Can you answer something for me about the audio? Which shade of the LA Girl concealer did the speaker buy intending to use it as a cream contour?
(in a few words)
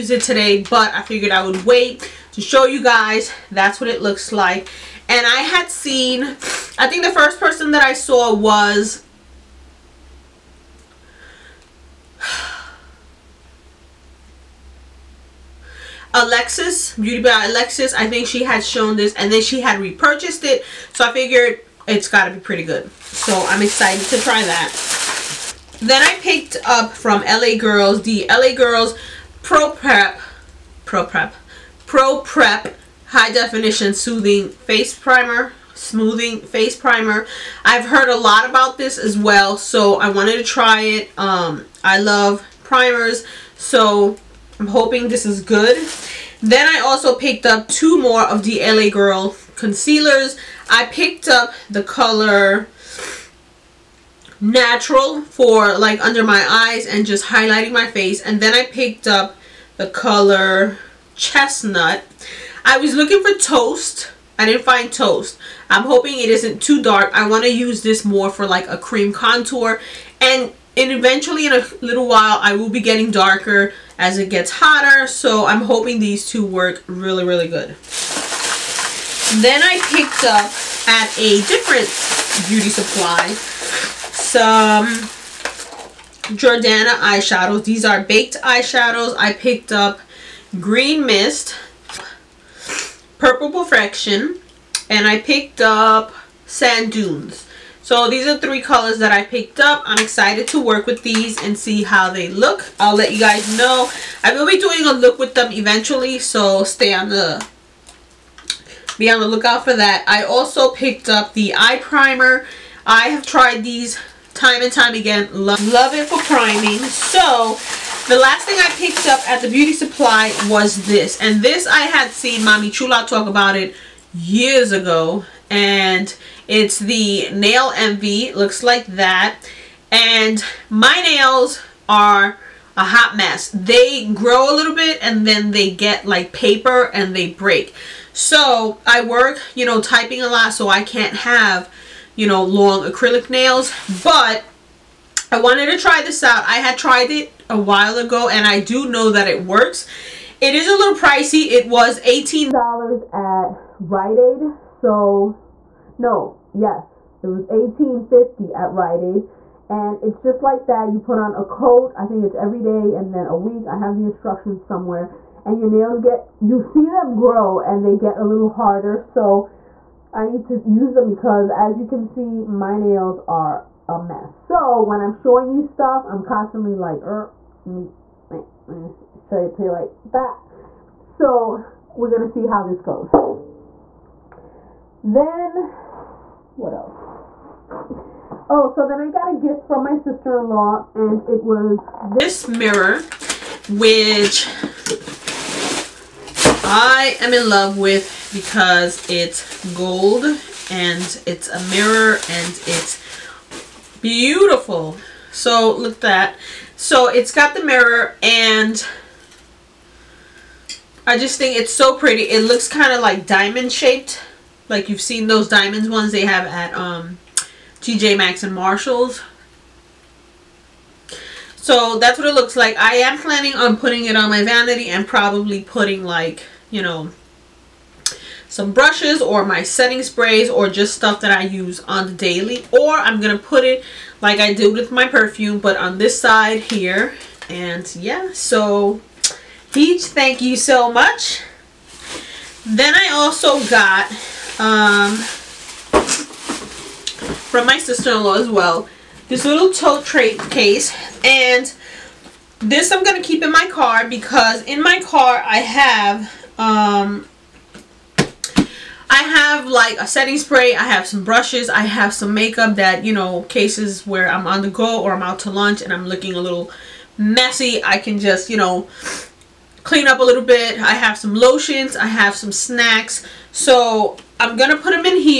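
Chestnut.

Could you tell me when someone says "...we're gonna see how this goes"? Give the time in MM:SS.
03:01.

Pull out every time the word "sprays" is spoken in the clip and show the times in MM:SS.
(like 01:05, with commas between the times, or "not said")
03:50, 04:20.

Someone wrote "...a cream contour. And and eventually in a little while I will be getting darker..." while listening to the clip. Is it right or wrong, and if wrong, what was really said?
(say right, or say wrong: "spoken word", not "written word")
right.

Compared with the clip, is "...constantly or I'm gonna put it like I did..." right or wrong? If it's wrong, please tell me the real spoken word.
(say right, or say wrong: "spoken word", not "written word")
wrong: "daily", not "constantly".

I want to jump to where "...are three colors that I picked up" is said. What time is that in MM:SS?
01:38.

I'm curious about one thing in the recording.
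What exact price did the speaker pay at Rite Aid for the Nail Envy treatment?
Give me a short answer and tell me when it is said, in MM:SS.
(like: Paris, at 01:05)
$18.50, at 02:37.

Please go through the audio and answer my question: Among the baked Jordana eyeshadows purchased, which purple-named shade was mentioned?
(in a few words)
Purple Perfection.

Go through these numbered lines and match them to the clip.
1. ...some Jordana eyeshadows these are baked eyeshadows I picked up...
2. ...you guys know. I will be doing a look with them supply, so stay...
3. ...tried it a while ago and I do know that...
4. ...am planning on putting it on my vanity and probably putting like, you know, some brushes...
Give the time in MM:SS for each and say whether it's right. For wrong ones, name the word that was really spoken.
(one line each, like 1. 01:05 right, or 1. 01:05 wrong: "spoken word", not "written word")
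1. 01:23 right
2. 01:43 wrong: "eventually", not "supply"
3. 02:26 right
4. 03:42 right.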